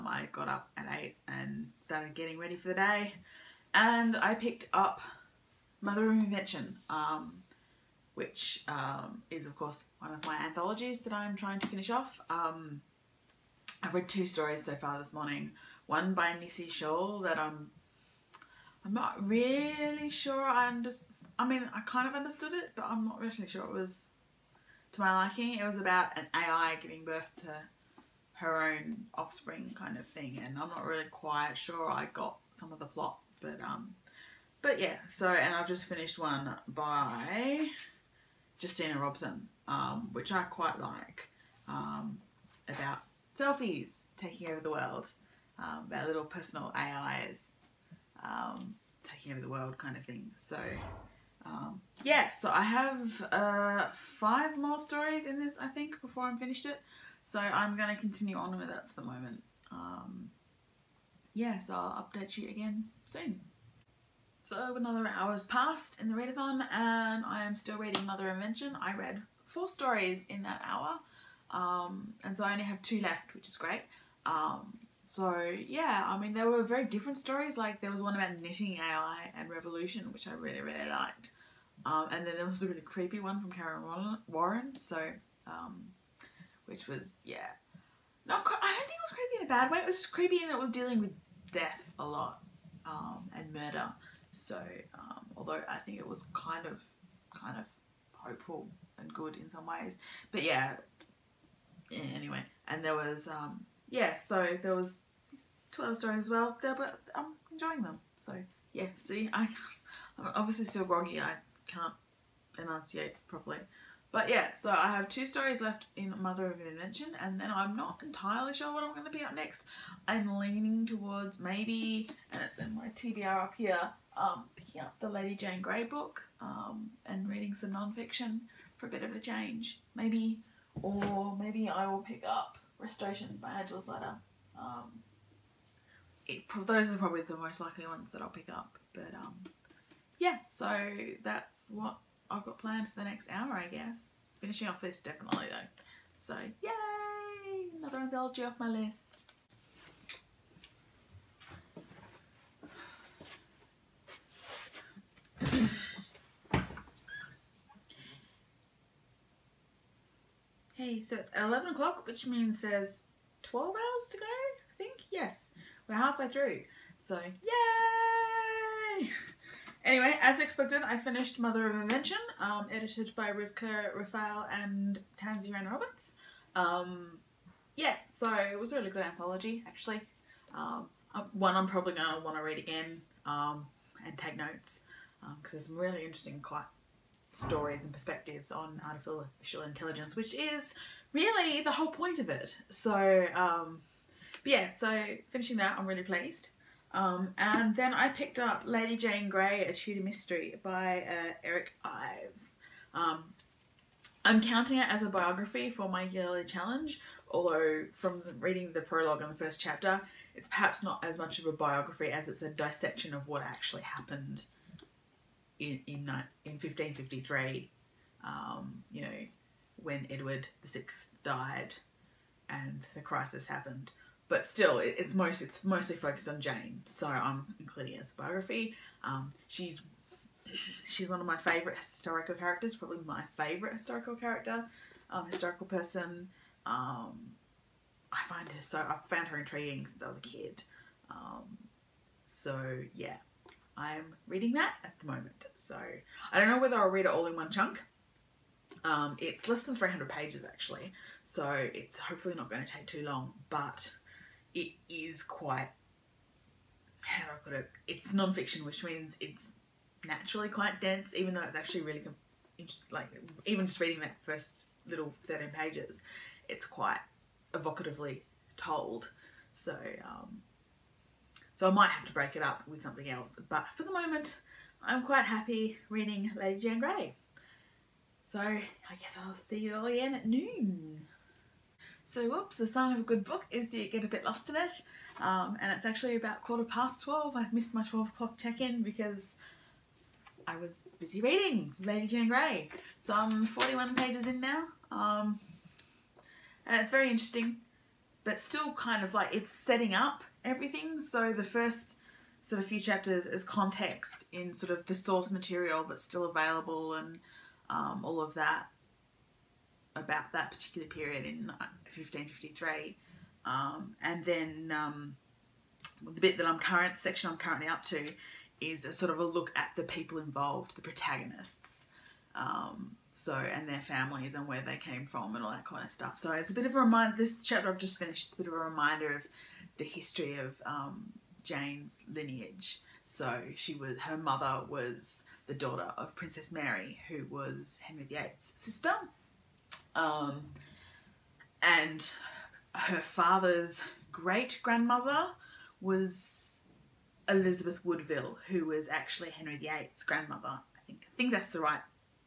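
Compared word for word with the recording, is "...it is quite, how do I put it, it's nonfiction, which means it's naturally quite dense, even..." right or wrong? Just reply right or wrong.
right.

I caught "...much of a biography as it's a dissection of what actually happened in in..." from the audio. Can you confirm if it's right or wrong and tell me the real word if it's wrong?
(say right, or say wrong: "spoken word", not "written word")
right.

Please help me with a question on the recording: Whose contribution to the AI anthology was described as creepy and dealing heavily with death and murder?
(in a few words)
Kaaron Warren.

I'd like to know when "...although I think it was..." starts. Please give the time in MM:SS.
01:35.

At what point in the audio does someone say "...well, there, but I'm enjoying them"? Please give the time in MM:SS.
01:46.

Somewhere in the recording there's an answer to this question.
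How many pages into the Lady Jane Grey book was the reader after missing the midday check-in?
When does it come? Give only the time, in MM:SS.
04:53.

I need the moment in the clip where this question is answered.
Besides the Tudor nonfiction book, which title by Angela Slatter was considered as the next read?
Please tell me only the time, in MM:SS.
02:12.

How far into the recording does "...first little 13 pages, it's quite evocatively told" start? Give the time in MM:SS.
04:24.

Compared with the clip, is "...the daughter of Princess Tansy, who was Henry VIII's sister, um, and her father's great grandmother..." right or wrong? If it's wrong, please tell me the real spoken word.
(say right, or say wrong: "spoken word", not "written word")
wrong: "Mary", not "Tansy".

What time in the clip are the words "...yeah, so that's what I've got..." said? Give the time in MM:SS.
02:20.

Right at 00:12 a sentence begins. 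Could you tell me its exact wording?
Um, I've read two stories so far this morning.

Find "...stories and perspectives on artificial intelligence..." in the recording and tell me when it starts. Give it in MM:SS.
03:07.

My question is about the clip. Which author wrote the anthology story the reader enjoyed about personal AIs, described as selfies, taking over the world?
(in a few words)
Justina Robson.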